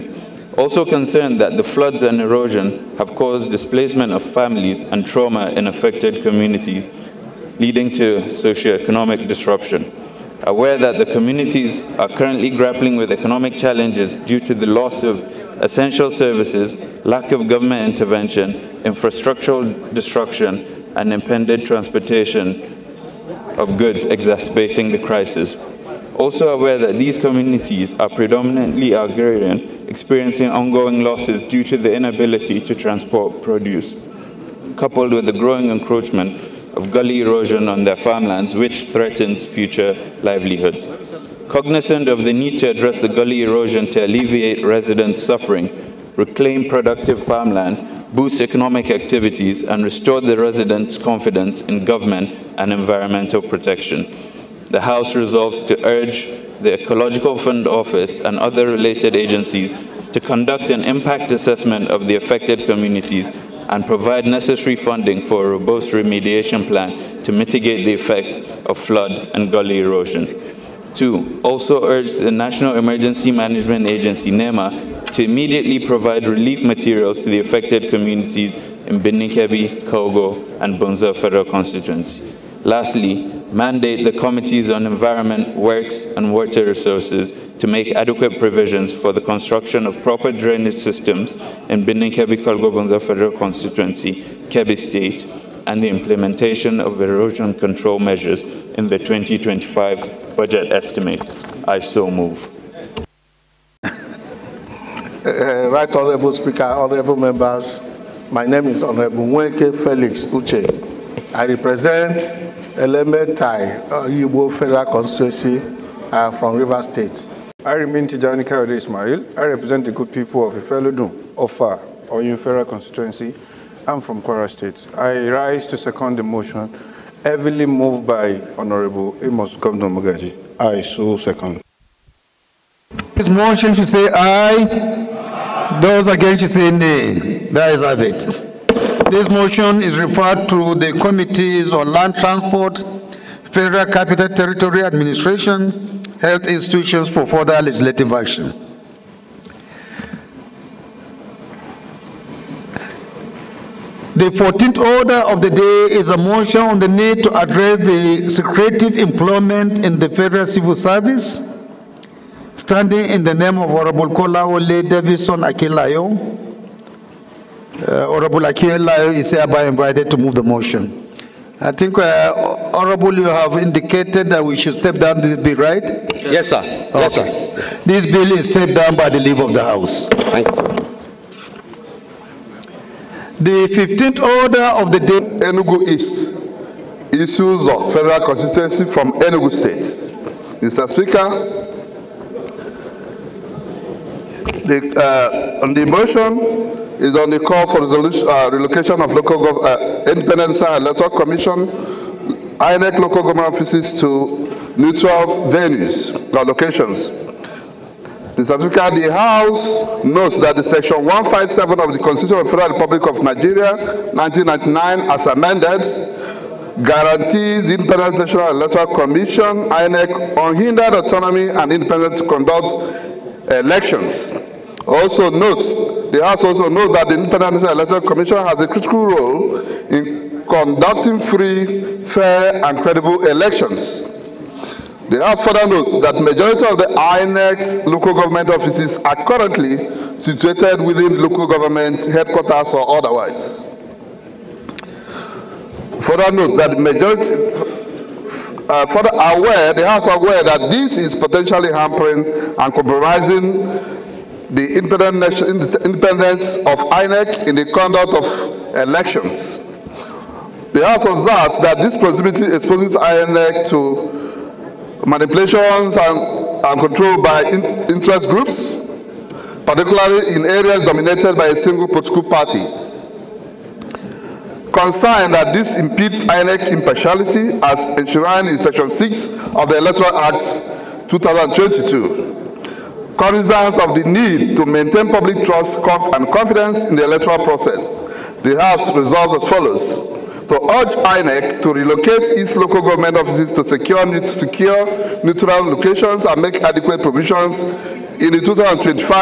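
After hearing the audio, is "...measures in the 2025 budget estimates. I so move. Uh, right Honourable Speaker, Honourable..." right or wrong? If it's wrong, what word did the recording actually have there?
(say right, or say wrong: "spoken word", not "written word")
right.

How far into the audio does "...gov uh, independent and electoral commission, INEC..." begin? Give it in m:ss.
3:19.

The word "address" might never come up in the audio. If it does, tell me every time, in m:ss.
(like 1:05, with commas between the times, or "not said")
0:42, 2:37.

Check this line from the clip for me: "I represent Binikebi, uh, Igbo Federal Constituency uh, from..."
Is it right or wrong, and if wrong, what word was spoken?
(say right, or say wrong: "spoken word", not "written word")
wrong: "Elementai", not "Binikebi".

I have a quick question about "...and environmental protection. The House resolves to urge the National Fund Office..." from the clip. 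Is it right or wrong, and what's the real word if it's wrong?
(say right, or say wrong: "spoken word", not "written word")
wrong: "Ecological", not "National".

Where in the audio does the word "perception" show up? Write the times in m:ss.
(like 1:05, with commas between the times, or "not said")
not said.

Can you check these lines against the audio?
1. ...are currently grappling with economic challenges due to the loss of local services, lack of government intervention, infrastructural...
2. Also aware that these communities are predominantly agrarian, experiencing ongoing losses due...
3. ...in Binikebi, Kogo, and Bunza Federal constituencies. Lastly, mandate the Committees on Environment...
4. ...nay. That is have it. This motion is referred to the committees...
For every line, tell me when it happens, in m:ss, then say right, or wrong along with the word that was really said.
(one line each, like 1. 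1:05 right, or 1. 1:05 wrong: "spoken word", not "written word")
1. 0:11 wrong: "essential", not "local"
2. 0:26 right
3. 1:18 right
4. 2:16 right.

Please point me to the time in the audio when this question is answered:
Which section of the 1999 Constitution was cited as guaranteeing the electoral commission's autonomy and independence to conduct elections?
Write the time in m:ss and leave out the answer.
3:30.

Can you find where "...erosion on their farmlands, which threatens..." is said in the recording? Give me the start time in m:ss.
0:37.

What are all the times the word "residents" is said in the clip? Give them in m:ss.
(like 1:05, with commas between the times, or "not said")
0:44, 0:50.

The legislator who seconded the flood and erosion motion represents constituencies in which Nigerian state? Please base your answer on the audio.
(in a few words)
Kwara State.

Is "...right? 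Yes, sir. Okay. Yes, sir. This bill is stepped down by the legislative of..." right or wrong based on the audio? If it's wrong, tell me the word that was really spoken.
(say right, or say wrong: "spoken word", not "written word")
wrong: "leave", not "legislative".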